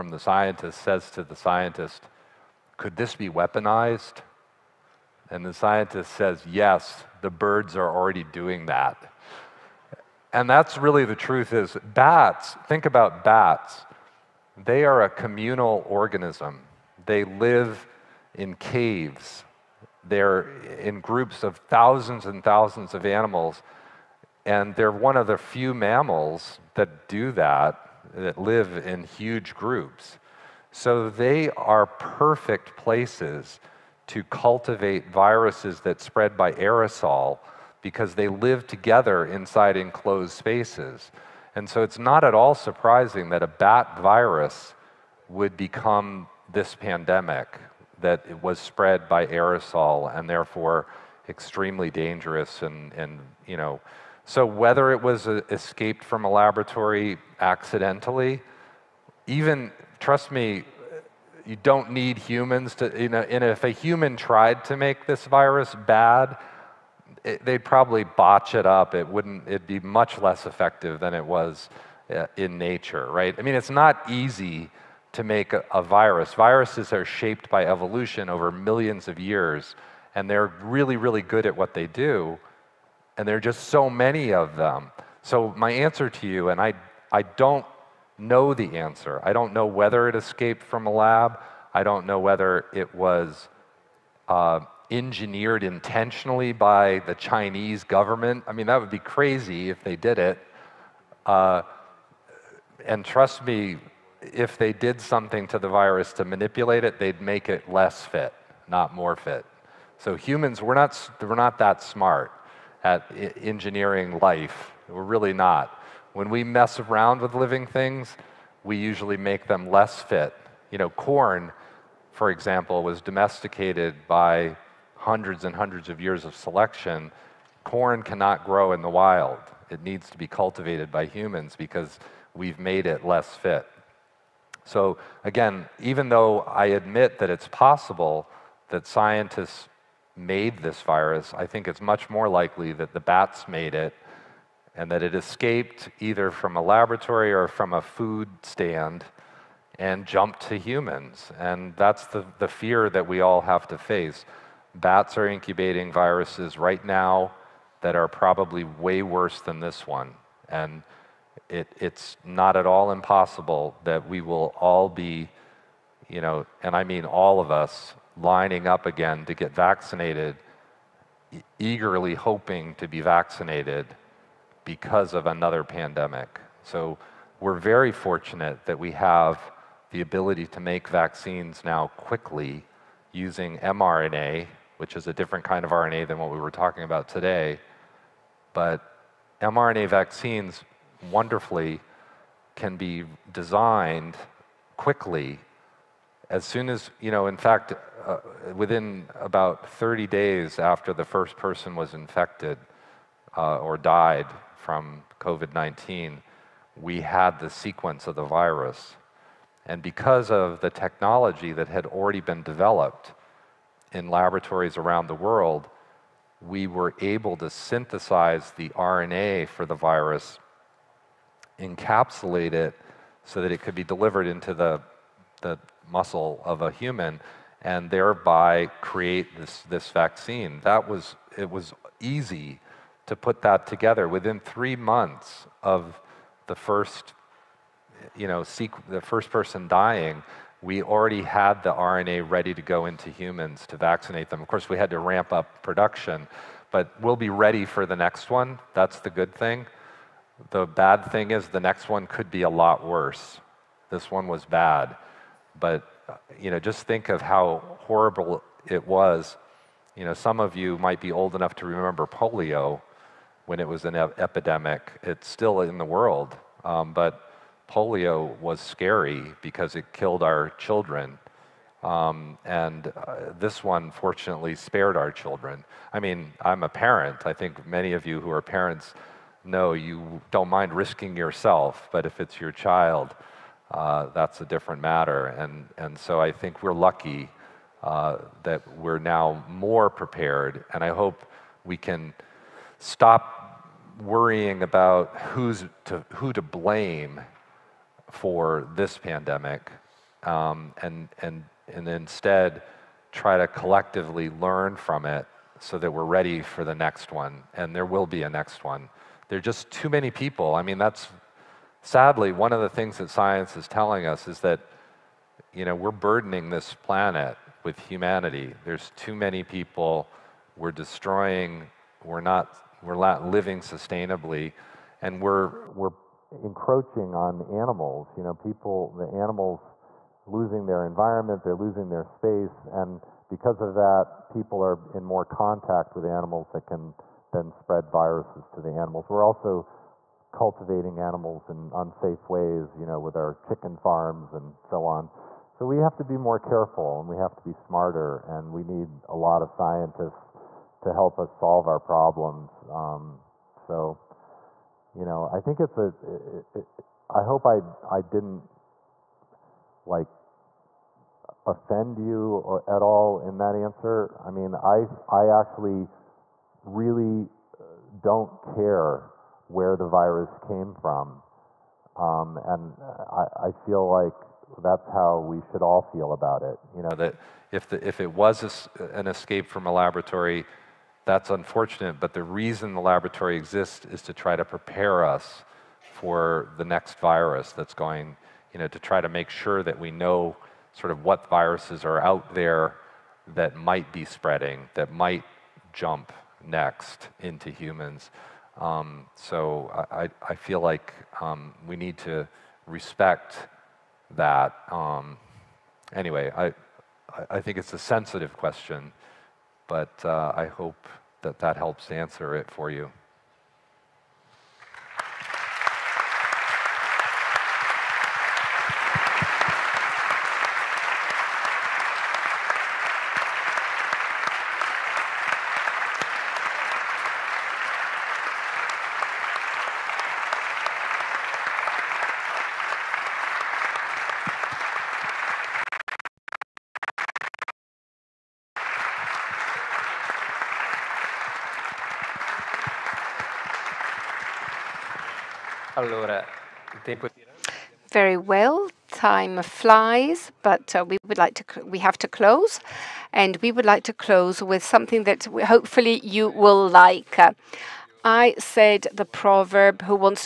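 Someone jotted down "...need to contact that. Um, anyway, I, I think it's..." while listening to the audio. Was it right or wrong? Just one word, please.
wrong.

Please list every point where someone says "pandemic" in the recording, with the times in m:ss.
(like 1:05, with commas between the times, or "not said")
0:46, 2:55, 4:58.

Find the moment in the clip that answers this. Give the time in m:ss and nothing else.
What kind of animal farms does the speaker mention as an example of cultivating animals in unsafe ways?
5:43.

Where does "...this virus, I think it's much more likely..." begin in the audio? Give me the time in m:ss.
2:20.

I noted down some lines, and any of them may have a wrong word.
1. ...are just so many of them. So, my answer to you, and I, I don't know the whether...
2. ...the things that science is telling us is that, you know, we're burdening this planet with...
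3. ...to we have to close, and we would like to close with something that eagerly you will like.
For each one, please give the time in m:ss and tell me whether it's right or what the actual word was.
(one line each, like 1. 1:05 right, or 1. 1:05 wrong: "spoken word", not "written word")
1. 1:23 wrong: "answer", not "whether"
2. 5:12 right
3. 7:31 wrong: "hopefully", not "eagerly".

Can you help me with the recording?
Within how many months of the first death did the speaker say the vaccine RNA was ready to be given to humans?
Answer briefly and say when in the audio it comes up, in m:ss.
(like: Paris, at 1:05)
3, at 3:54.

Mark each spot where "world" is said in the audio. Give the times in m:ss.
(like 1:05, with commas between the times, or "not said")
3:35, 4:25.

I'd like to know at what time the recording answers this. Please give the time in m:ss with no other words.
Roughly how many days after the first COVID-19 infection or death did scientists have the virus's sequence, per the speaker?
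3:19.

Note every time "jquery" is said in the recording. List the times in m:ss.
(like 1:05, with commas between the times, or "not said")
not said.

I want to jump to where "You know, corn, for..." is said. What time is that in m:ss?
2:00.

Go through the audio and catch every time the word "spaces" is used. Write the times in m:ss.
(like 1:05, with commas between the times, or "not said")
0:40, 5:32.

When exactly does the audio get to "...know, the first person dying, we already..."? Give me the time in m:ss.
3:58.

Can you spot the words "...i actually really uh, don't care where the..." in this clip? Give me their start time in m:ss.
6:05.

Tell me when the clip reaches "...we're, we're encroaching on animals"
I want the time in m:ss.
5:25.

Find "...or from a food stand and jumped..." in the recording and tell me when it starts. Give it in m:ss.
2:27.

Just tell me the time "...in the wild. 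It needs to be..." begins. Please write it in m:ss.
2:08.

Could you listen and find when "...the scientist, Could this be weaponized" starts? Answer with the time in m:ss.
0:01.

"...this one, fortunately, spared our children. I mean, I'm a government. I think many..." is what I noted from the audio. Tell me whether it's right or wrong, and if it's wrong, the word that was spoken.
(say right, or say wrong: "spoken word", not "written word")
wrong: "parent", not "government".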